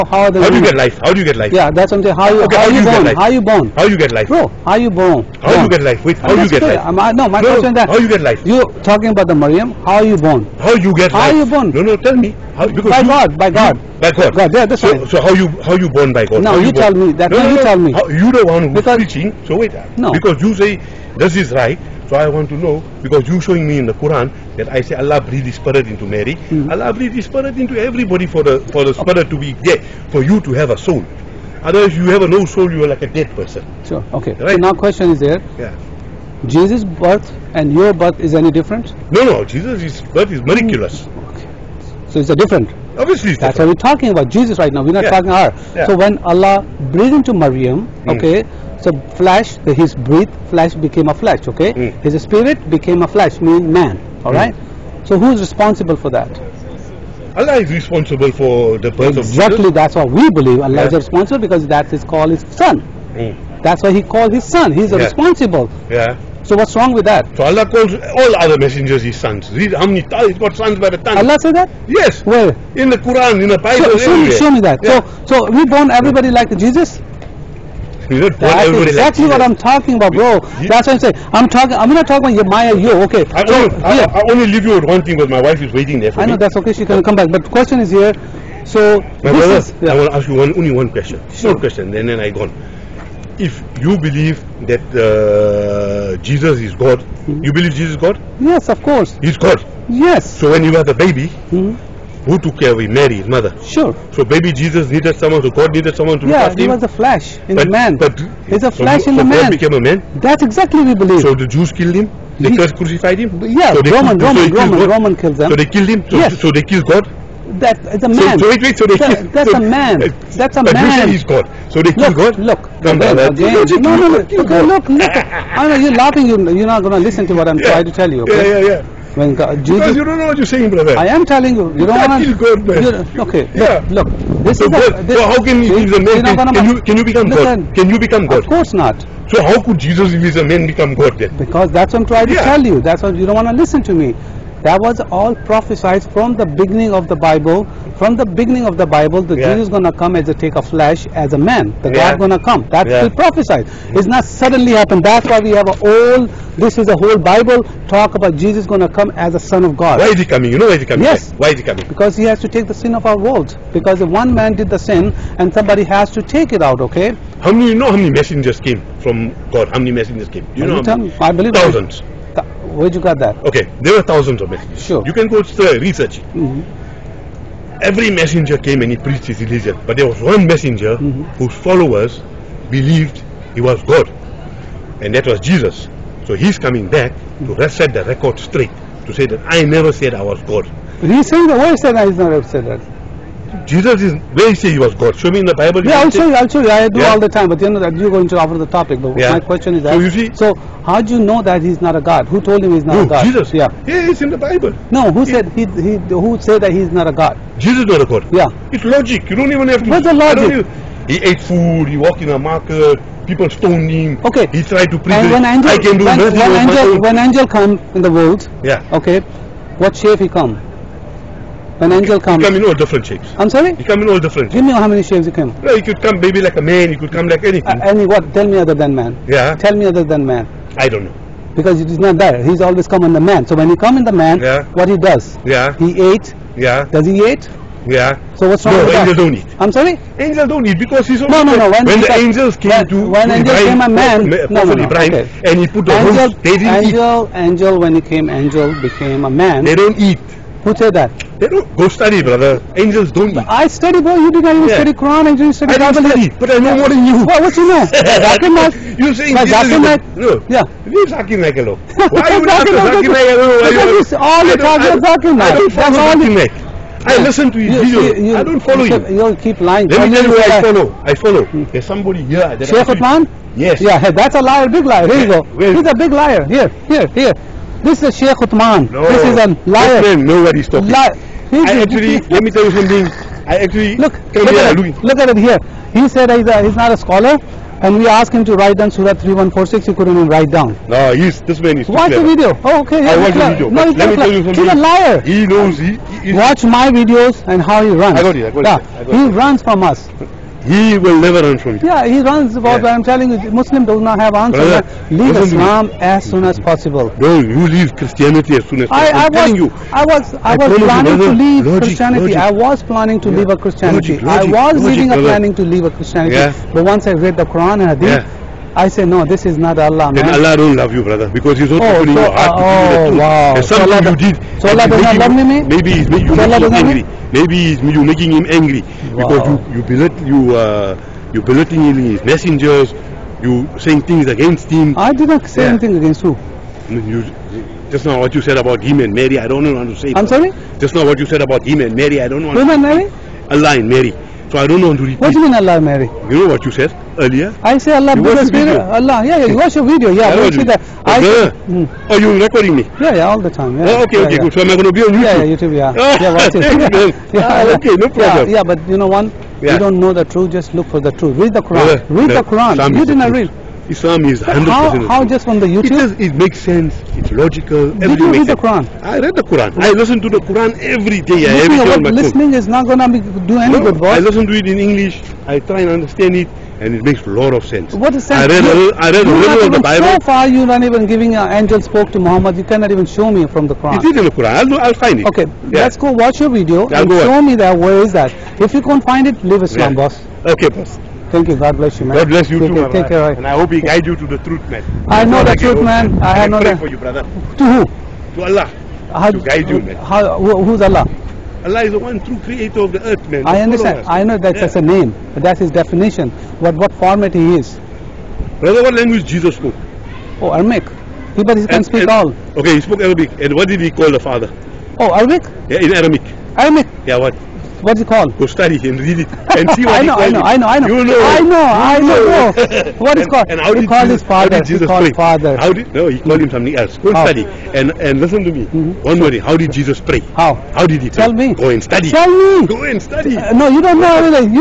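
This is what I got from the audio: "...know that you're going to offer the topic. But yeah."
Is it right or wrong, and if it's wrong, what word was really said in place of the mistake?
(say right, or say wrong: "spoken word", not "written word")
right.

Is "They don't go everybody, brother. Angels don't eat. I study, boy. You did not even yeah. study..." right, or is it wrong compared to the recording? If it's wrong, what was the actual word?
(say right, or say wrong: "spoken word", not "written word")
wrong: "study", not "everybody".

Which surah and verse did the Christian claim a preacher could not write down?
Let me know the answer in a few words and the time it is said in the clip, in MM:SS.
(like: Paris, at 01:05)
Surah 3146, at 04:48.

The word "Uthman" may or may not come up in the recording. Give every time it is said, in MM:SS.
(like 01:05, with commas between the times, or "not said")
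04:32, 04:38.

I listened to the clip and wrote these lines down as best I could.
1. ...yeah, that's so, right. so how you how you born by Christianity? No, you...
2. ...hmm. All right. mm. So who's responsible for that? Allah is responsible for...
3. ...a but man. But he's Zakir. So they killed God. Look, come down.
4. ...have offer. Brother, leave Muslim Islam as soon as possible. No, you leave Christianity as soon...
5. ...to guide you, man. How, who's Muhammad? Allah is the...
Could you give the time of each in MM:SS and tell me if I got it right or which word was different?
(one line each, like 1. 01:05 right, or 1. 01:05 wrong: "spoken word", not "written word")
1. 00:14 wrong: "God", not "Christianity"
2. 00:53 right
3. 02:00 wrong: "God", not "Zakir"
4. 05:04 wrong: "answer", not "offer"
5. 06:39 wrong: "Allah", not "Muhammad".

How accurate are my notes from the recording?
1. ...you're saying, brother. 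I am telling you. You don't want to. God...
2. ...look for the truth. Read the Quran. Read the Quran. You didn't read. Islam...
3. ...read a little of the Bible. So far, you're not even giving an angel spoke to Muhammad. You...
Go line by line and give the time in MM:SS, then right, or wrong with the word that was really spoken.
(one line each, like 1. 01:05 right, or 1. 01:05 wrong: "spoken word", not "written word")
1. 02:10 right
2. 06:00 right
3. 06:19 right.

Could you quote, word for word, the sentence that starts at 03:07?
set the record straight, to say that I never said I was God.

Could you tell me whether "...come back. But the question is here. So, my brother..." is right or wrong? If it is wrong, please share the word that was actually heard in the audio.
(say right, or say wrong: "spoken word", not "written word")
right.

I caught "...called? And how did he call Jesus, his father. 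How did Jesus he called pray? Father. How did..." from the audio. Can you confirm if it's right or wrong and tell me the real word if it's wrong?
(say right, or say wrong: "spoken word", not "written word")
right.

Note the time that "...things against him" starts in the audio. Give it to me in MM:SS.
05:34.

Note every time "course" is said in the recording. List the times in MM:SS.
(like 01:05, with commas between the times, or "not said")
01:38, 02:18.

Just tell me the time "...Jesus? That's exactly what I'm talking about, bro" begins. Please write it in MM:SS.
01:16.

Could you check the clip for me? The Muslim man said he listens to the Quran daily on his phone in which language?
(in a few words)
English.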